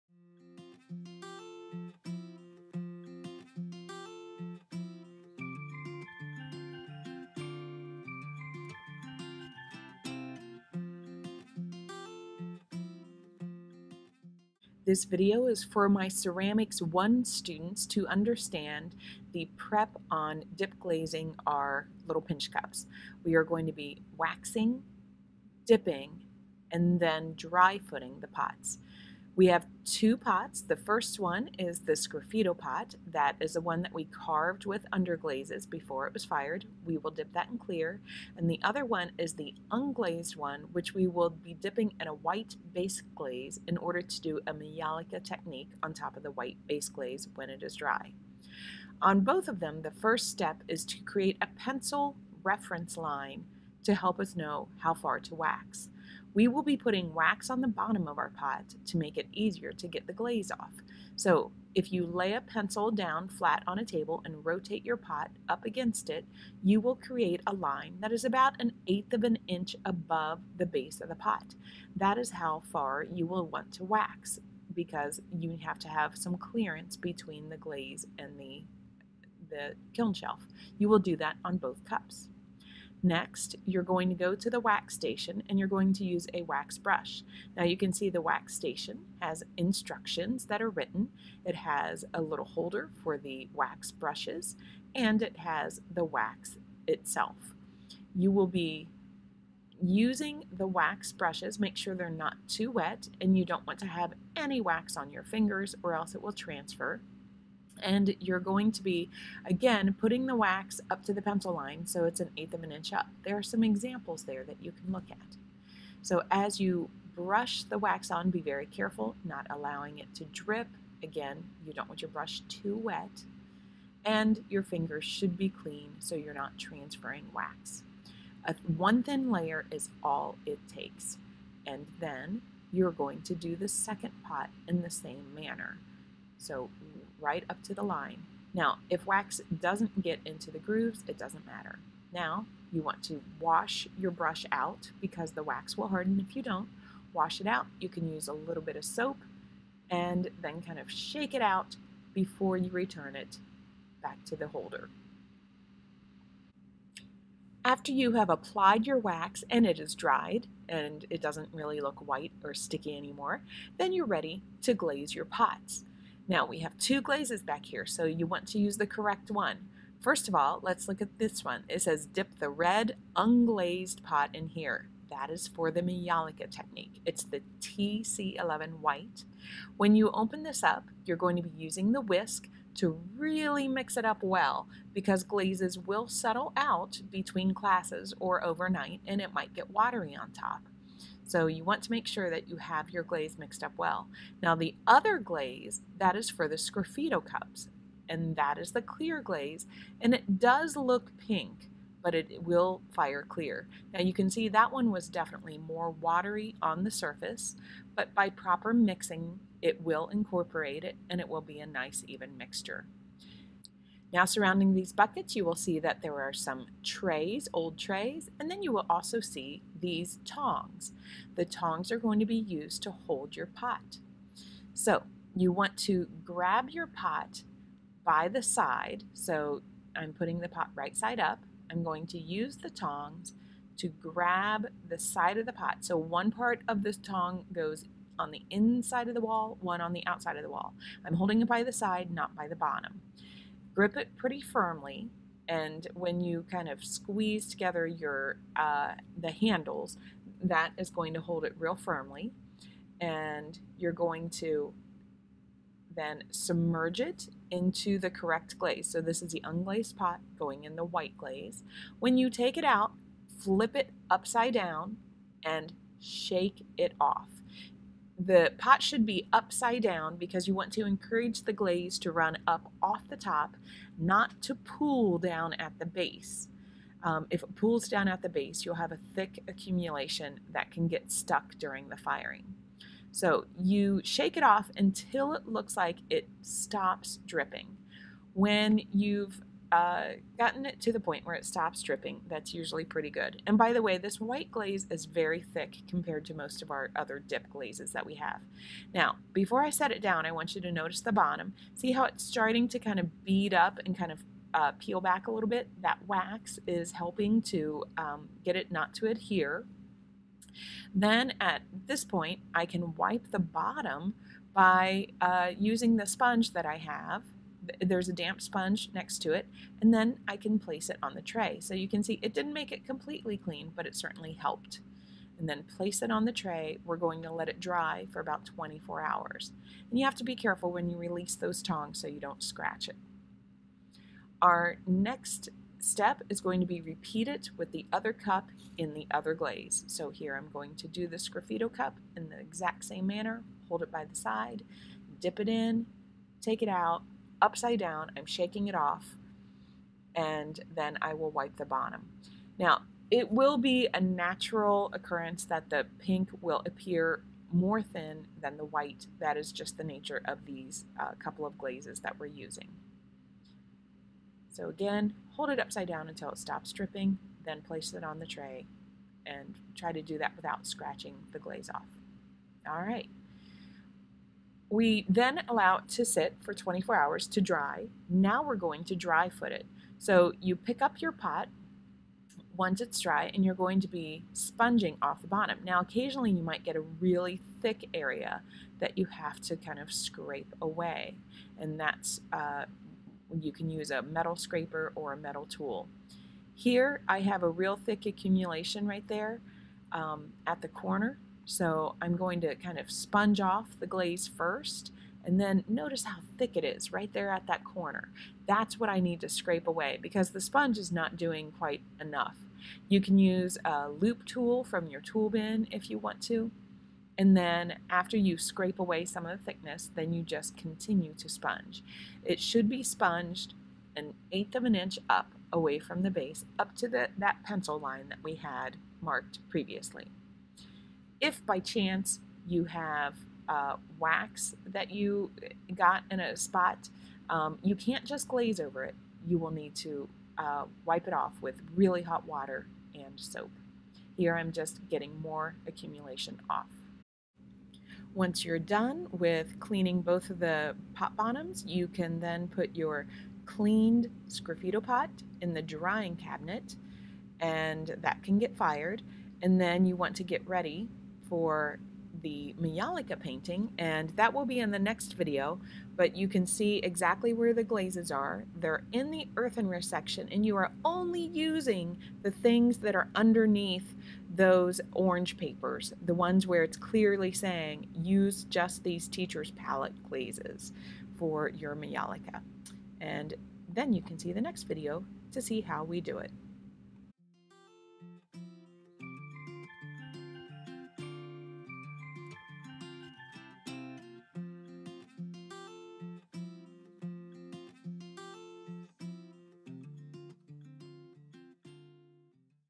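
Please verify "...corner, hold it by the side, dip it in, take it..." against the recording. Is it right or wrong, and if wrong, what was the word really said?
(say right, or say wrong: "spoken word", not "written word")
wrong: "manner", not "corner".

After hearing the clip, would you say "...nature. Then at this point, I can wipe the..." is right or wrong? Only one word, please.
wrong.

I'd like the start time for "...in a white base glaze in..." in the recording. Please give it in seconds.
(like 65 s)
42 s.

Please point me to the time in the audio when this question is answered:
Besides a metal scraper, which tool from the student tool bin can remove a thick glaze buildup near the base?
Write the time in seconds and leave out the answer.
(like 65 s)
413 s.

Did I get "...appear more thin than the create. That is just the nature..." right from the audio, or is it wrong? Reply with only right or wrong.
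wrong.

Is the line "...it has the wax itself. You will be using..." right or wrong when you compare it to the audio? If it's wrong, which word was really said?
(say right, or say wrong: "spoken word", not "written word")
right.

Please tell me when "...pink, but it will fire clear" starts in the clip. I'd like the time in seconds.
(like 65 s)
201 s.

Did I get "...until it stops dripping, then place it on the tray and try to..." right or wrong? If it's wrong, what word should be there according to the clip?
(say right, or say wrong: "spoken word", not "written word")
right.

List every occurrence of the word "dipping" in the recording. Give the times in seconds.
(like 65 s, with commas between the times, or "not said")
25 s, 41 s.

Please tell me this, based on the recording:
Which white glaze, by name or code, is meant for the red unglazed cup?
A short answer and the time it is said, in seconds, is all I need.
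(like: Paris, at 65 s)
TC11 white, at 177 s.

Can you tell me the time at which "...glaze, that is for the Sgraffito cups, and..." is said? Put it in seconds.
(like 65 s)
195 s.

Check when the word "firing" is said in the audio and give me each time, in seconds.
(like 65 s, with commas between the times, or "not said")
281 s.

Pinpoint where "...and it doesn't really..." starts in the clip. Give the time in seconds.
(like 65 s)
160 s.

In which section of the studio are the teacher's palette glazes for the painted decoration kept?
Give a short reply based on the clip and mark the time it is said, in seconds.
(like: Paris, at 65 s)
earthenware section, at 469 s.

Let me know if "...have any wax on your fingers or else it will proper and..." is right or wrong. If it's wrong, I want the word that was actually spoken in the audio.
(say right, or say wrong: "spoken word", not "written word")
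wrong: "transfer", not "proper".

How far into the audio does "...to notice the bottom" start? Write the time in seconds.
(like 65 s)
300 s.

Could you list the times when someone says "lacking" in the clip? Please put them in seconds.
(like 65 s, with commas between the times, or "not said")
not said.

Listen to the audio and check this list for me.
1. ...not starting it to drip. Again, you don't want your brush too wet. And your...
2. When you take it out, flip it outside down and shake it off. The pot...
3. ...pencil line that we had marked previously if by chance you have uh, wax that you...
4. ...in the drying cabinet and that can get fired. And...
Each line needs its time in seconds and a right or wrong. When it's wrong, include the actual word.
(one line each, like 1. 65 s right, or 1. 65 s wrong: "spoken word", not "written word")
1. 119 s wrong: "allowing", not "starting"
2. 261 s wrong: "upside", not "outside"
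3. 427 s right
4. 455 s right.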